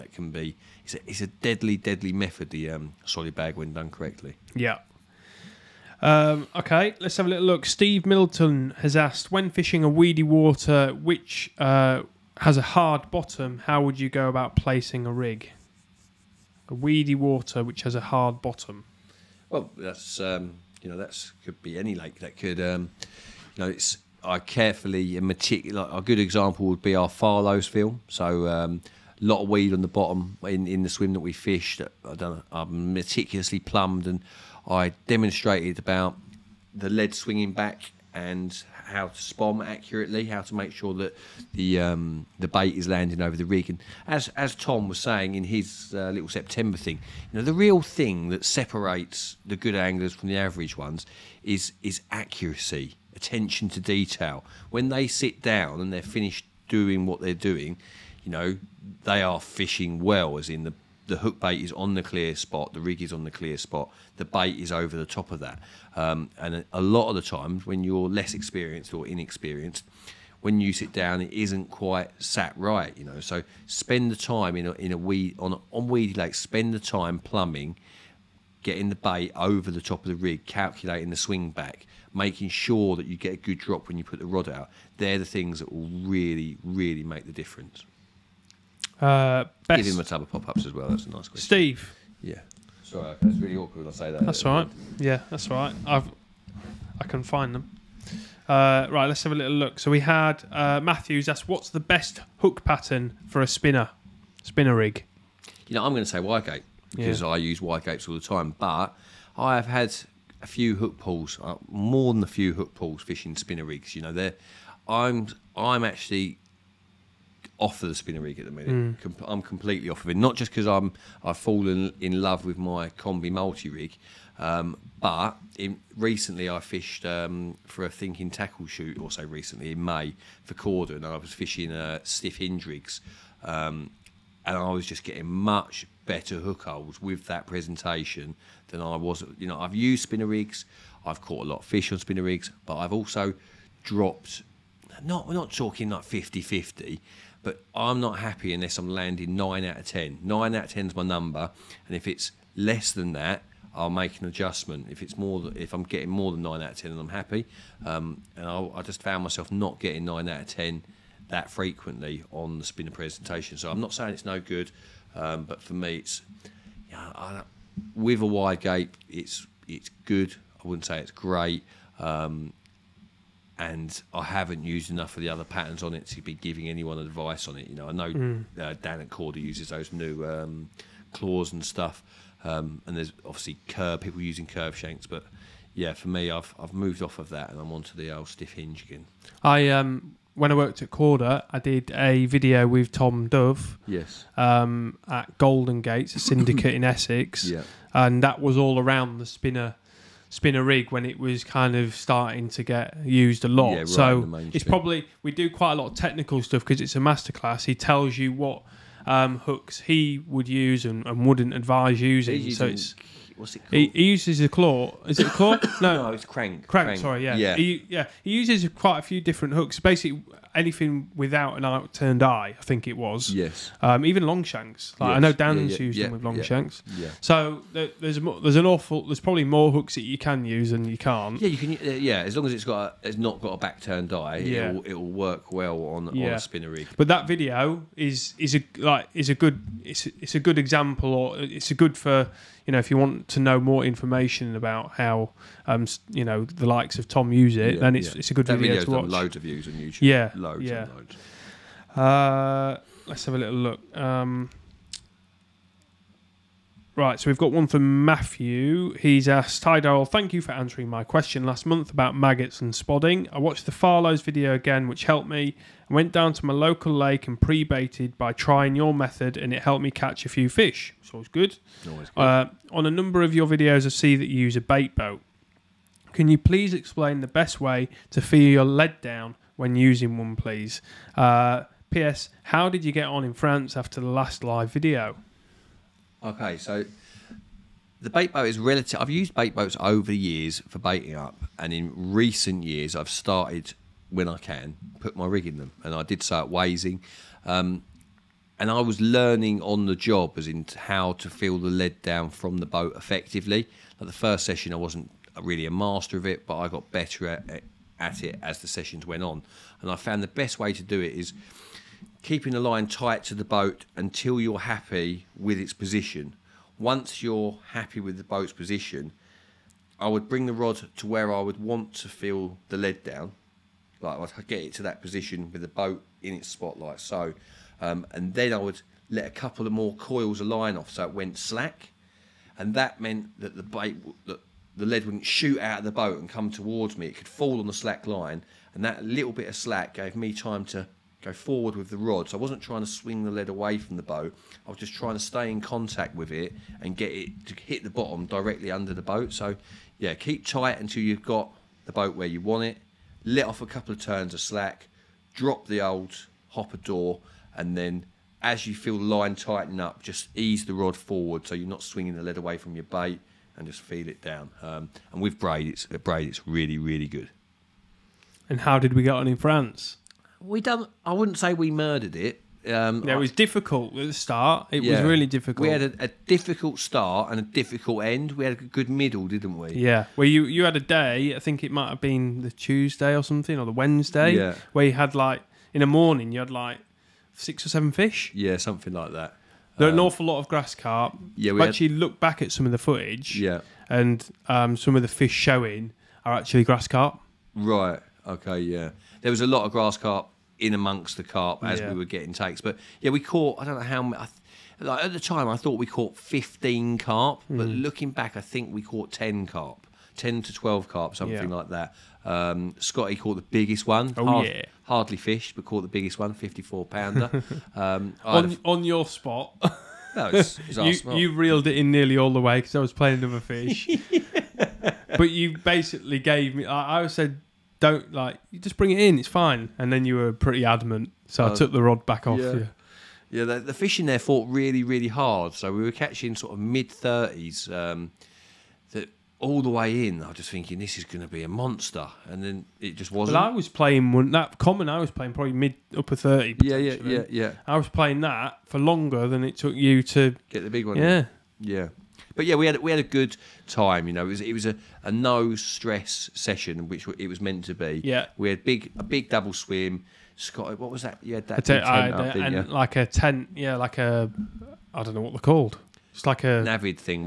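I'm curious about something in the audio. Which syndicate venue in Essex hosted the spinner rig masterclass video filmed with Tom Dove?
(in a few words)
Golden Gates.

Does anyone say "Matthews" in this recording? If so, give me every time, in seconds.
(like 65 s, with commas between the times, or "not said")
100 s, 258 s.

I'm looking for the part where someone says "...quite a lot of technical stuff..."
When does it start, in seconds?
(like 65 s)
205 s.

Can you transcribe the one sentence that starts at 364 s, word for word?
Um, and with braid, it's uh, braid, it's really really good.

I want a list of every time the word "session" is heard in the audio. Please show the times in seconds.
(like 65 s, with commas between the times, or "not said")
304 s, 308 s, 456 s.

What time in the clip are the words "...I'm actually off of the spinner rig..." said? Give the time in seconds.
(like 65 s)
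115 s.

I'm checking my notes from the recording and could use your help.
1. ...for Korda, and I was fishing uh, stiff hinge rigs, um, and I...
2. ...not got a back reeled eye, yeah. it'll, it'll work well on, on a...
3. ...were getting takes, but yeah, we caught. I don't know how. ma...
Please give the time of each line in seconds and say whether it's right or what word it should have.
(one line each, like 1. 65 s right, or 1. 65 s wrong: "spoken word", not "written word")
1. 130 s right
2. 233 s wrong: "turned", not "reeled"
3. 401 s right.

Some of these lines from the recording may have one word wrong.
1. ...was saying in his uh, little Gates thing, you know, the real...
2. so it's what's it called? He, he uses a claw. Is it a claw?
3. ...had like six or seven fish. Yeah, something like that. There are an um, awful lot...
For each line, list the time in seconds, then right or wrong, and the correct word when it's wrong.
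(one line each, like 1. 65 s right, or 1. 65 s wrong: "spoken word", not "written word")
1. 44 s wrong: "September", not "Gates"
2. 212 s right
3. 386 s right.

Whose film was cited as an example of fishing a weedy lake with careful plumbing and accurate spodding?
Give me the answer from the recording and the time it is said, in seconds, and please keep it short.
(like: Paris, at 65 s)
Farlow's film, at 27 s.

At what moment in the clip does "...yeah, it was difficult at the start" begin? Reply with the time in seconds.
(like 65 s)
373 s.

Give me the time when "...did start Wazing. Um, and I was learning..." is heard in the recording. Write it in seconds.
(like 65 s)
296 s.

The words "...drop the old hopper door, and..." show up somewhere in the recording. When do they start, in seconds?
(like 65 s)
355 s.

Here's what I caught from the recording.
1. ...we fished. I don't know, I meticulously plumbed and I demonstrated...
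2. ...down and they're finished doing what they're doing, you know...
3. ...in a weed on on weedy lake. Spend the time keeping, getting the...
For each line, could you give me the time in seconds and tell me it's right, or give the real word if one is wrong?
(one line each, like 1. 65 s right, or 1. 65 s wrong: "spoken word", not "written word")
1. 31 s right
2. 55 s right
3. 74 s wrong: "plumbing", not "keeping".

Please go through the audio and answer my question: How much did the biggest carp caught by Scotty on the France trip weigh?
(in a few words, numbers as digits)
54 pounds.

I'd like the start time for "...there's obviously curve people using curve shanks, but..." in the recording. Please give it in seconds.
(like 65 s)
182 s.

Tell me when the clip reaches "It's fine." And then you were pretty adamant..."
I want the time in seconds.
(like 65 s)
429 s.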